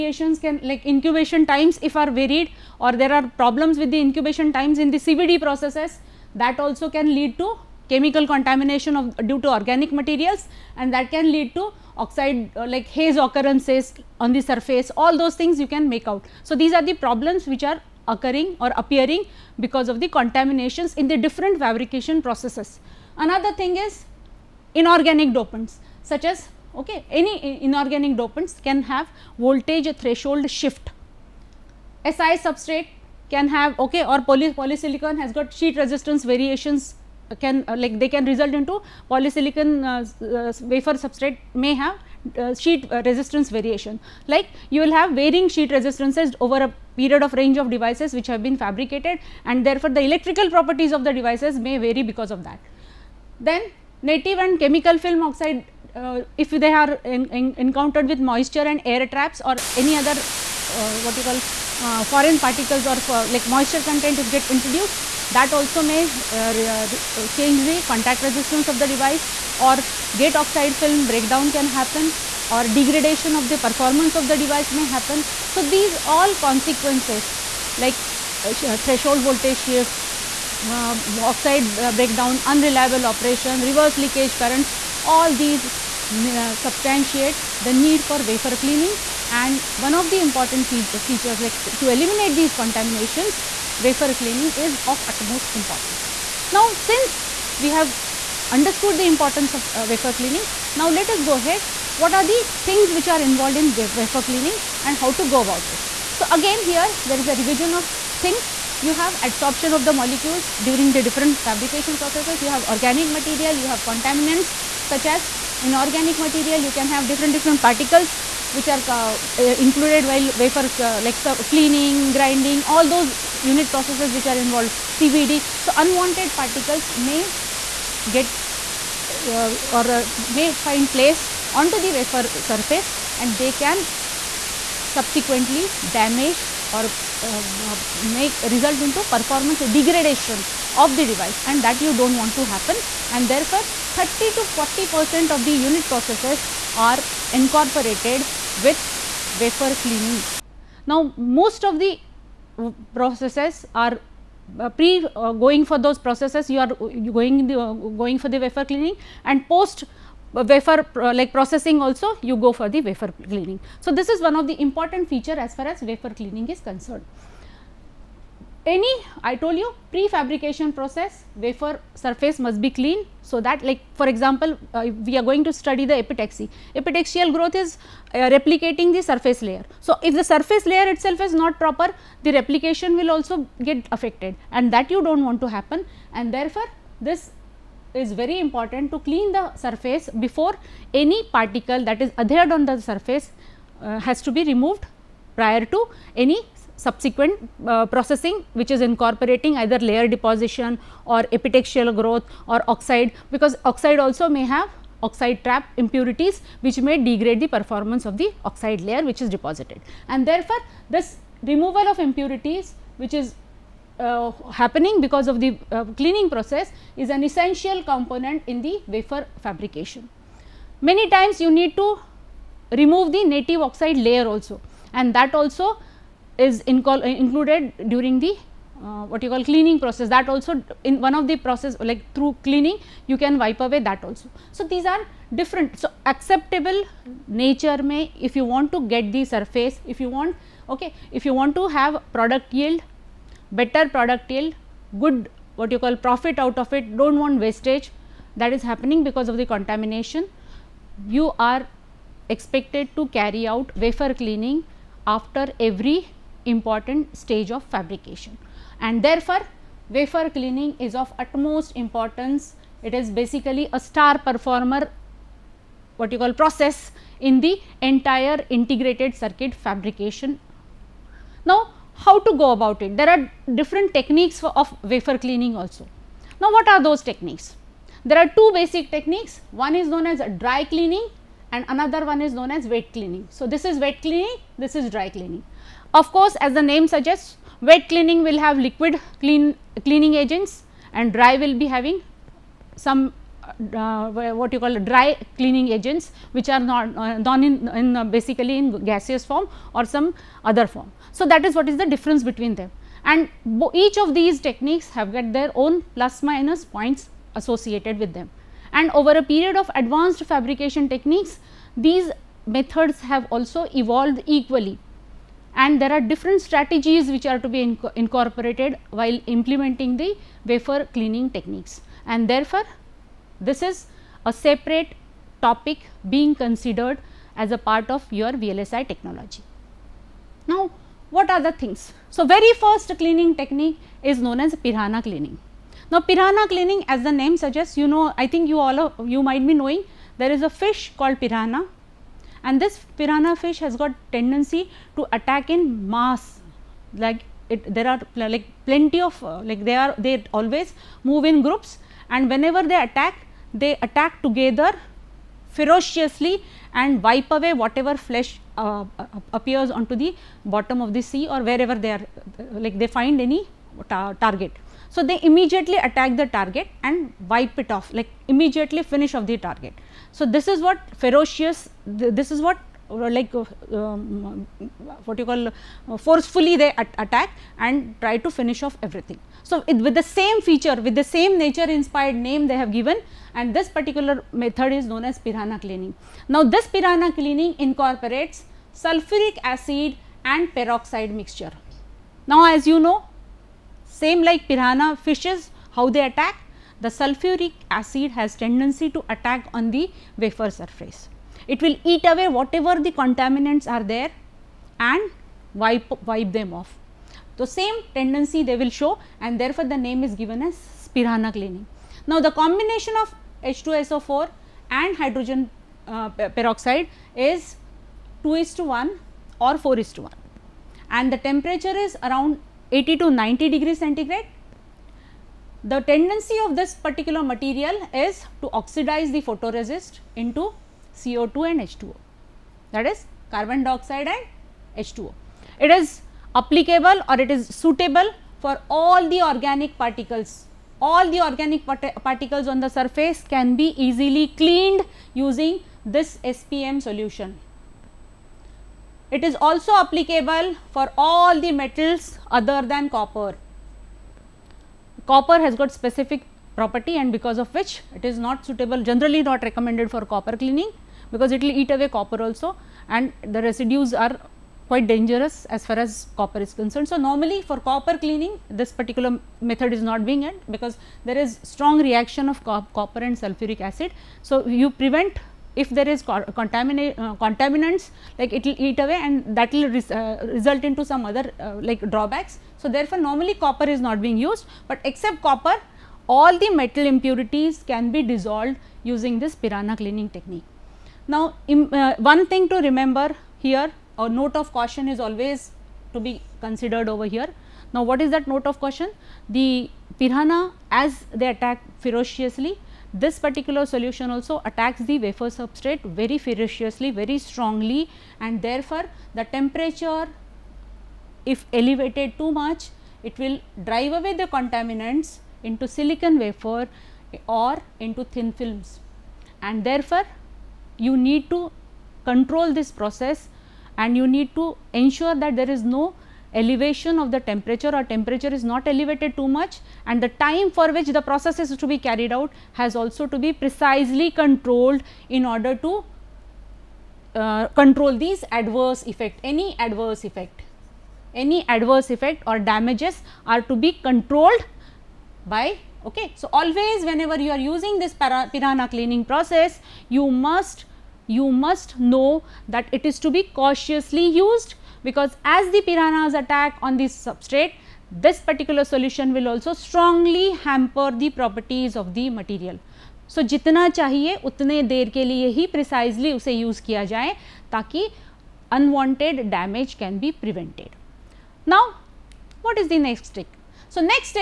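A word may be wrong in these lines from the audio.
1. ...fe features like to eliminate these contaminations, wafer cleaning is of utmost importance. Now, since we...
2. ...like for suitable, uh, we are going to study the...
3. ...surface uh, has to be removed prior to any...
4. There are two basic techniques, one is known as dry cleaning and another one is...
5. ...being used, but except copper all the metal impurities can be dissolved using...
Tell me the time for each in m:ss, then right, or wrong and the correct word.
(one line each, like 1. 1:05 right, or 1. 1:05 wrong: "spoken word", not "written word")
1. 1:30 right
2. 2:53 wrong: "example", not "suitable"
3. 3:12 right
4. 4:38 right
5. 8:04 right.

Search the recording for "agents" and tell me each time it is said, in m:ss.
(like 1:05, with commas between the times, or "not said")
4:50, 4:55.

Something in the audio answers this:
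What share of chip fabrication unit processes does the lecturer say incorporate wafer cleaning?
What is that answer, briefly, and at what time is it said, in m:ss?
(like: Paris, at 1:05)
30 to 40 percent, at 2:23.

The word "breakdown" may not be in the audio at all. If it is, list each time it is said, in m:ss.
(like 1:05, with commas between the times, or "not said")
1:11, 1:21.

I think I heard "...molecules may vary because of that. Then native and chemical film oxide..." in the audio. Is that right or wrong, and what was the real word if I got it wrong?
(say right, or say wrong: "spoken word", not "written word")
wrong: "devices", not "molecules".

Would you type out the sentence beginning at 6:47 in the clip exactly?
The same tendency they will show and therefore, the name is given as piranha cleaning.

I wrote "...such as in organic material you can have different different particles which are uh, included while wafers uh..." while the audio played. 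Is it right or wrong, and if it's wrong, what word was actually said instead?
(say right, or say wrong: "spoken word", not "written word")
right.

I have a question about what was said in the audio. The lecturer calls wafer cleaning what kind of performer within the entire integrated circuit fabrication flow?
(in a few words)
Star performer.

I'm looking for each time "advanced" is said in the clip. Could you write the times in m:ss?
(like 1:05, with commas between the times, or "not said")
5:09.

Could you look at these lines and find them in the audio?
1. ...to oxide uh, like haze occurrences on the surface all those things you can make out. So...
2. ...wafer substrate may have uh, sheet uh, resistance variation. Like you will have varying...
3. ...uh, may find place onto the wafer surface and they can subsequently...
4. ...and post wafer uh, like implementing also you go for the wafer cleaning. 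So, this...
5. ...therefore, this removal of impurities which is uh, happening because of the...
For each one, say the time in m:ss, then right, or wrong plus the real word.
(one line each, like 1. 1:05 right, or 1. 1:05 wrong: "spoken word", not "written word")
1. 0:11 right
2. 0:40 right
3. 2:09 right
4. 2:39 wrong: "processing", not "implementing"
5. 3:30 right.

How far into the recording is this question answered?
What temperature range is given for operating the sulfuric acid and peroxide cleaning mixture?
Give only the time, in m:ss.
7:02.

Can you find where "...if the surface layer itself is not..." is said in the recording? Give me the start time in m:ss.
3:00.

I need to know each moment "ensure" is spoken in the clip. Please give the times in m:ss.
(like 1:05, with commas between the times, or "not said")
8:44.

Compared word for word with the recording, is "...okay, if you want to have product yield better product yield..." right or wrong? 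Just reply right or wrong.
right.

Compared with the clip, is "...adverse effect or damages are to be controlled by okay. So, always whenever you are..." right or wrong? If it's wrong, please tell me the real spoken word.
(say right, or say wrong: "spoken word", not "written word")
right.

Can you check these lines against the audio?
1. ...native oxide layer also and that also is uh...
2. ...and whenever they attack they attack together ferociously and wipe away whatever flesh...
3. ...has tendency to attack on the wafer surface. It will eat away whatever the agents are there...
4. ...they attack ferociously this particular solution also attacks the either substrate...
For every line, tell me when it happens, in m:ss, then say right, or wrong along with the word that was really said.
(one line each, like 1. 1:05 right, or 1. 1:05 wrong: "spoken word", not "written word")
1. 3:43 right
2. 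5:52 right
3. 6:38 wrong: "contaminants", not "agents"
4. 8:21 wrong: "wafer", not "either".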